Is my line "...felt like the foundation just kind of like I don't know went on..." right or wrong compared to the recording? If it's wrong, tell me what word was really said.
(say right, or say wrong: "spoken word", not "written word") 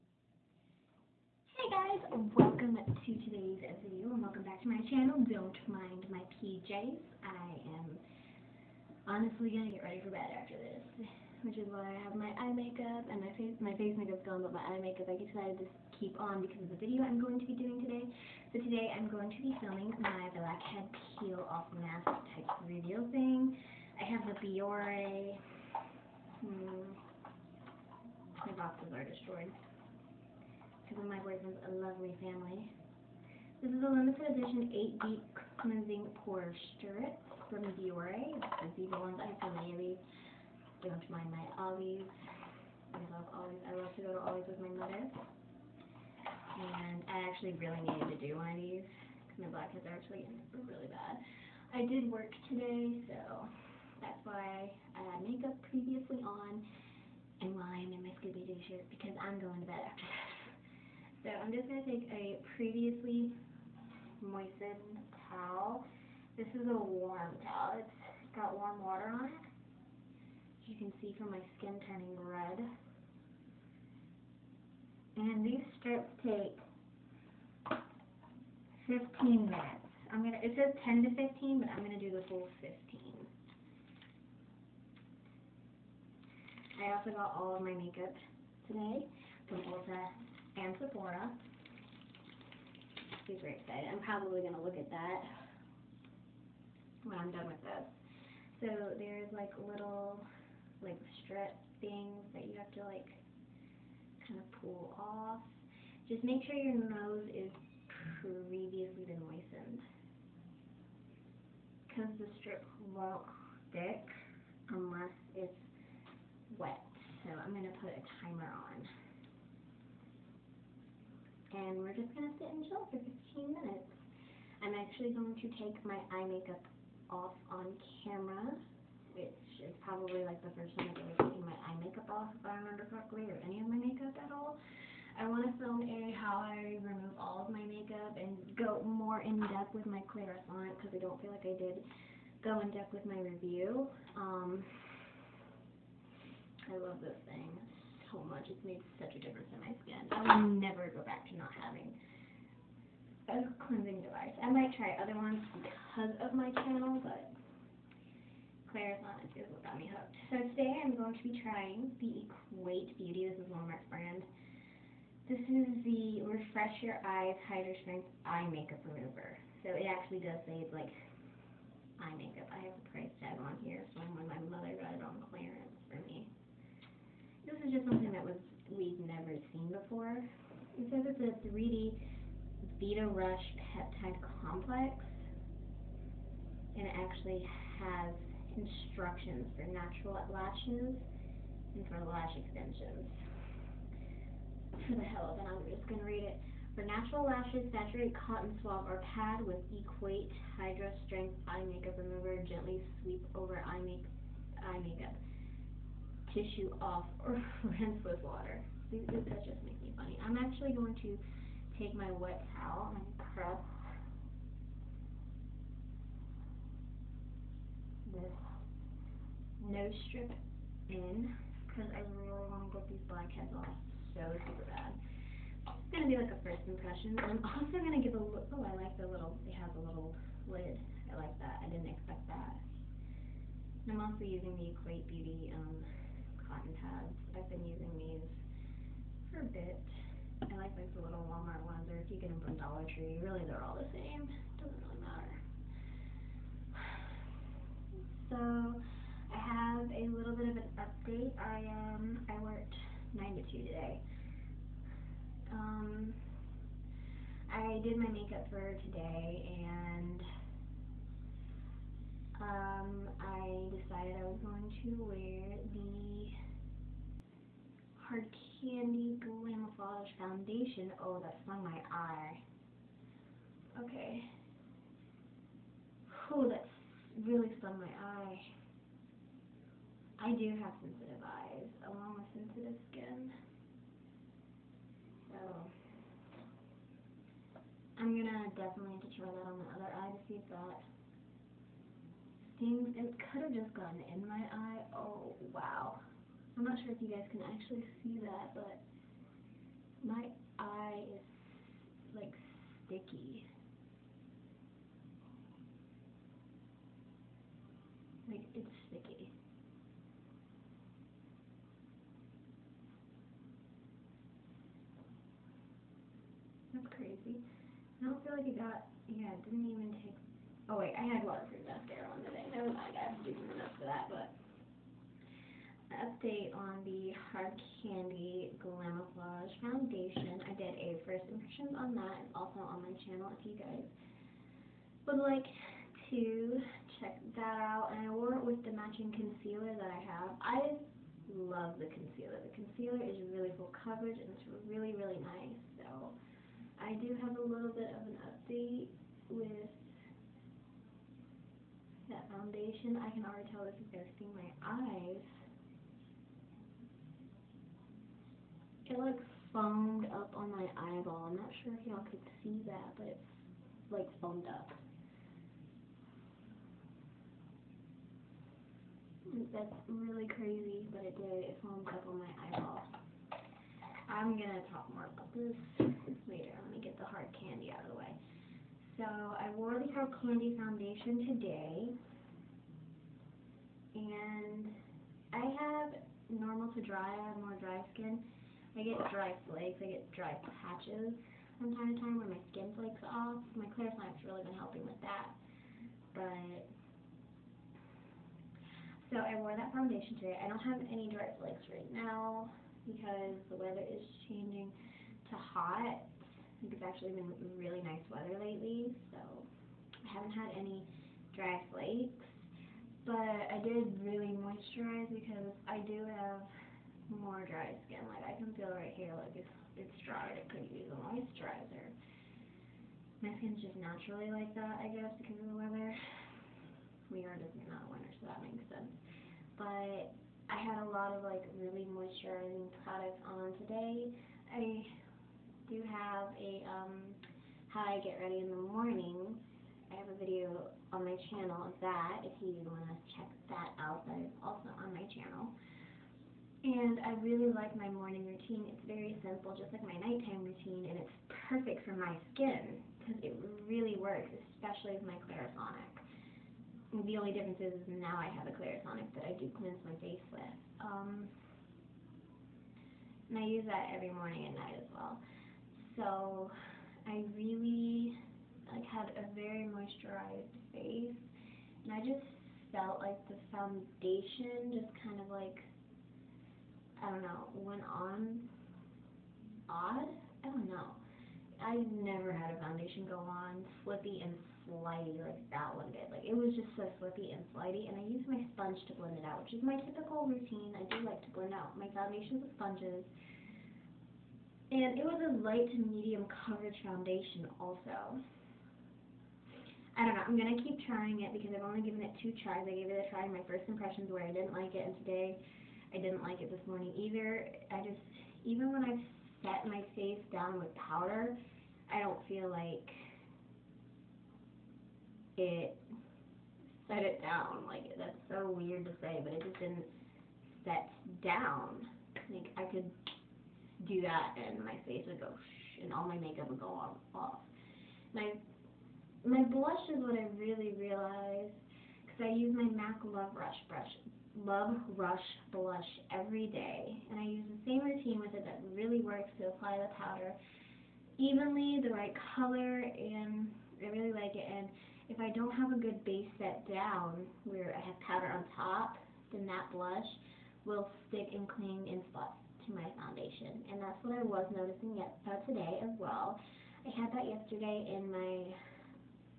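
right.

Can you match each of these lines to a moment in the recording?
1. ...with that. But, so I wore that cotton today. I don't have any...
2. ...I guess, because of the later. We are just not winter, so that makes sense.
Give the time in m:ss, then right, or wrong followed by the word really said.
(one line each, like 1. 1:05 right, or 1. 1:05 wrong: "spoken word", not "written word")
1. 6:34 wrong: "foundation", not "cotton"
2. 7:04 wrong: "weather", not "later".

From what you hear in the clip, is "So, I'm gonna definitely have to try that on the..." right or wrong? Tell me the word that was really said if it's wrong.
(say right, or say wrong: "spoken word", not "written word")
right.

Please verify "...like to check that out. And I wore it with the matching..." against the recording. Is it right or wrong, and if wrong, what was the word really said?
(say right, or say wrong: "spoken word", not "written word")
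right.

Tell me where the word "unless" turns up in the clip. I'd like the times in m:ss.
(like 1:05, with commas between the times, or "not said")
1:54.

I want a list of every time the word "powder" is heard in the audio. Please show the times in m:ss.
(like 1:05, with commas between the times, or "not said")
8:30, 9:00, 9:07.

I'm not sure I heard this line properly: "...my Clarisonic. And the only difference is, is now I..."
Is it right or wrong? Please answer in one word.
right.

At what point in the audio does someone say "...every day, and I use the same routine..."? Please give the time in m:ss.
8:56.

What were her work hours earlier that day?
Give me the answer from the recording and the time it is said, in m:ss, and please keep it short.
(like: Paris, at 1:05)
9 to 2, at 4:13.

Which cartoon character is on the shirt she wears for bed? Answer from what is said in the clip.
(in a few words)
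Scooby-Doo.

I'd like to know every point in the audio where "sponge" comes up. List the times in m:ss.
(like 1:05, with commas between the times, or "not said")
8:08, 8:12.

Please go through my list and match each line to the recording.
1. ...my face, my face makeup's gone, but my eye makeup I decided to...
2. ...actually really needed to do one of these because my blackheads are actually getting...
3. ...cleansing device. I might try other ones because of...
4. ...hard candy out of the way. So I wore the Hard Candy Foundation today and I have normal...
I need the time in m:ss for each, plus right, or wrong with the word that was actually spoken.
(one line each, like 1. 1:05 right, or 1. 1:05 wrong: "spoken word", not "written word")
1. 0:13 right
2. 0:47 right
3. 2:33 right
4. 6:17 right.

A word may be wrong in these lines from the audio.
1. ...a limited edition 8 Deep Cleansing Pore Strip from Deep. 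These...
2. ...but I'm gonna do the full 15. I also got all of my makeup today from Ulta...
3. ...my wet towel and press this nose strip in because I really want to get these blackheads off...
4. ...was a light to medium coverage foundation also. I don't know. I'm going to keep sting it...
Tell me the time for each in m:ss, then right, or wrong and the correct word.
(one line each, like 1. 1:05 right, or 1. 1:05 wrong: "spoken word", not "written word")
1. 0:33 wrong: "Biore", not "Deep"
2. 1:21 right
3. 3:31 right
4. 8:15 wrong: "trying", not "sting".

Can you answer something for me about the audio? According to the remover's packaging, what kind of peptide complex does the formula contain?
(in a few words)
3D beta rush peptide complex.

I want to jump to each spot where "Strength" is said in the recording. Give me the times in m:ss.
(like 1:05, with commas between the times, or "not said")
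2:47, 3:21.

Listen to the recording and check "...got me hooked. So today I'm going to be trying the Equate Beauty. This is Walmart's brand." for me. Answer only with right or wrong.
right.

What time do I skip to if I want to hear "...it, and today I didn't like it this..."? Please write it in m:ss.
8:24.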